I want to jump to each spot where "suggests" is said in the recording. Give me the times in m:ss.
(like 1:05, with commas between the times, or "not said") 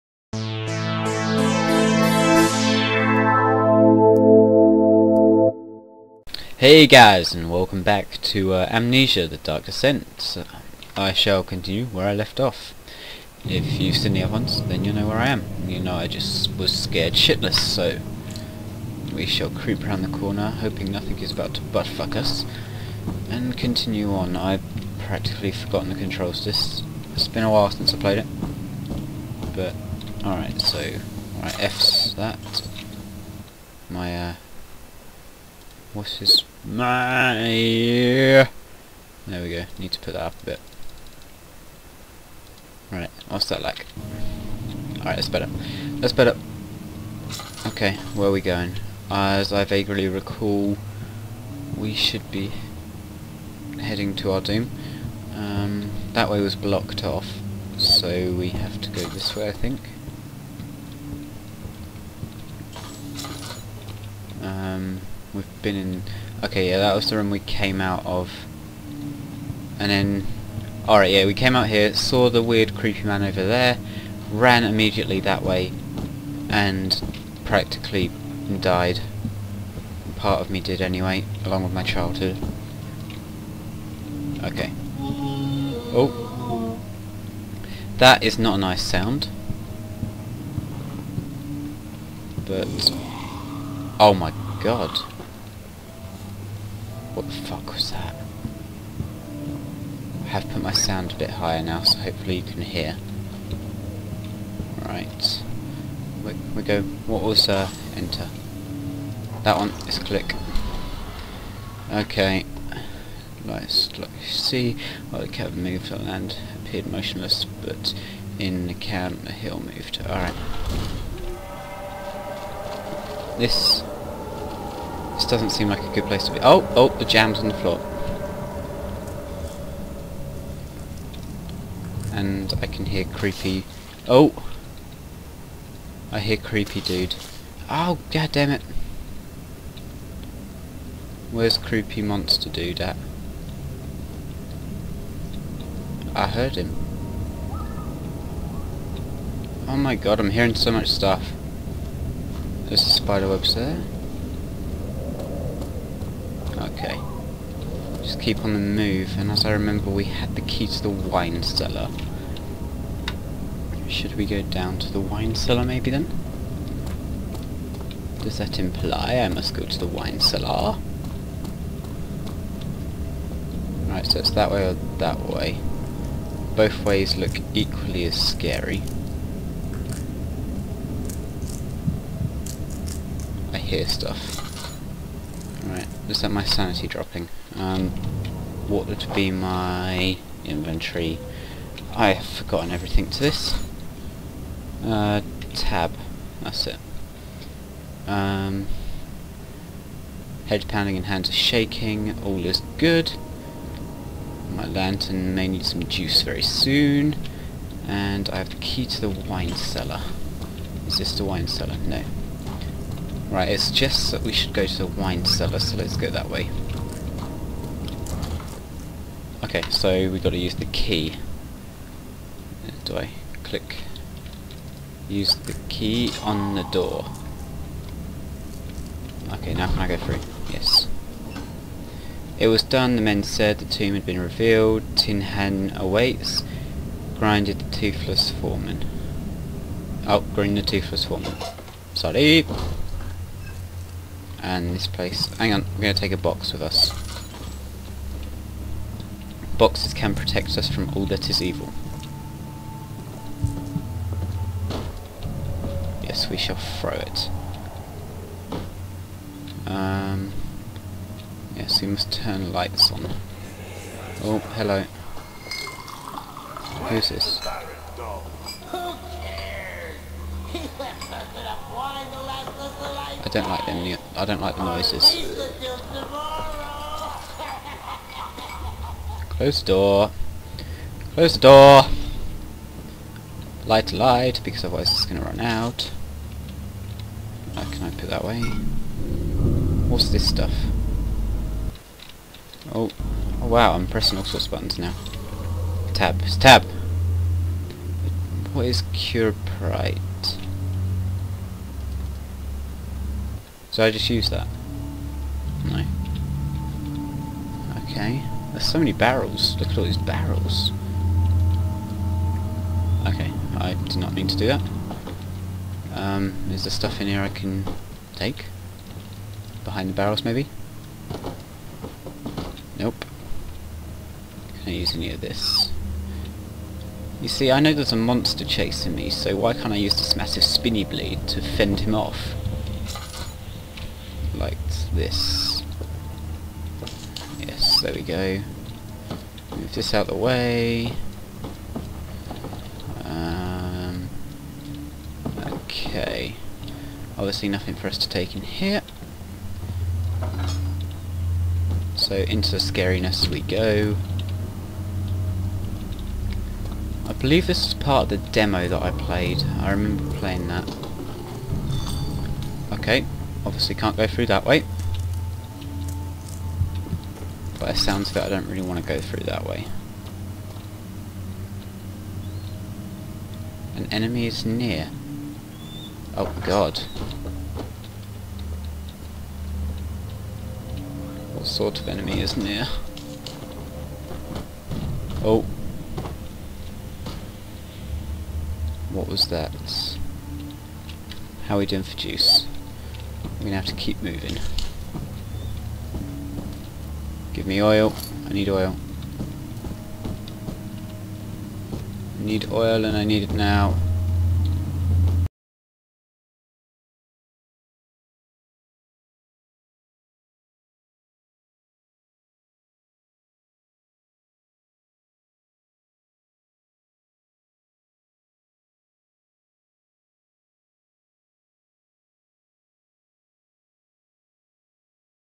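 3:33.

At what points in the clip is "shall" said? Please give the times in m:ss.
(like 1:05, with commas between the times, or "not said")
0:11, 0:19, 4:16.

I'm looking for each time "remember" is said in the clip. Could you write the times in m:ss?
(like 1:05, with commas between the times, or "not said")
2:39, 5:59.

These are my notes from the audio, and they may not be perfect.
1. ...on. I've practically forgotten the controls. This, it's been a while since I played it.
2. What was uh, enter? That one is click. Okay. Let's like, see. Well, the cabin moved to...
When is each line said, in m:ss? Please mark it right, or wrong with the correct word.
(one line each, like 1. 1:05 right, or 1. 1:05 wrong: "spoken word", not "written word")
1. 0:24 right
2. 1:47 right.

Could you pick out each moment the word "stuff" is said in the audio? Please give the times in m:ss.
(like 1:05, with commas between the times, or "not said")
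2:30, 3:03, 4:50, 5:16.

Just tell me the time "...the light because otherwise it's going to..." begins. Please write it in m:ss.
4:43.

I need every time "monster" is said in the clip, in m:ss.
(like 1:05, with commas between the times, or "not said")
2:22, 5:27.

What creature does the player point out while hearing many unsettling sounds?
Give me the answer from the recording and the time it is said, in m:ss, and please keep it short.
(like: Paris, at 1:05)
A spider, at 2:32.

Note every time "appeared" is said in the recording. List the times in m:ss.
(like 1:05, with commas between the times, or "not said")
1:56.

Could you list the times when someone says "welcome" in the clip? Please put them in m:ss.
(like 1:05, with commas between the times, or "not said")
0:07.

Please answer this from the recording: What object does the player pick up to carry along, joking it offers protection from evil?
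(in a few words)
A box.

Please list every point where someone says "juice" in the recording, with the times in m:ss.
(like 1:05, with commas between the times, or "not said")
3:25, 6:31.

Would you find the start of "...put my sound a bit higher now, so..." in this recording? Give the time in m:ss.
1:40.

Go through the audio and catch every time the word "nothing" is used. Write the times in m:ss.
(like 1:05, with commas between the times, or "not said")
0:20, 5:47.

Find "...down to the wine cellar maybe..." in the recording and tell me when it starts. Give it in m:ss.
2:44.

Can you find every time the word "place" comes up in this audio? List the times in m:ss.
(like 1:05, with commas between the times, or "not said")
2:06, 4:04.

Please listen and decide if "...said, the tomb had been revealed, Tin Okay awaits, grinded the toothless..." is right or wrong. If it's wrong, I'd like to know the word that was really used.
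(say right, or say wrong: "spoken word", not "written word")
wrong: "Hen", not "Okay".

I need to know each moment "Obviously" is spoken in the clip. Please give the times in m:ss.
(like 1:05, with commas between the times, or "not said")
5:47, 6:03.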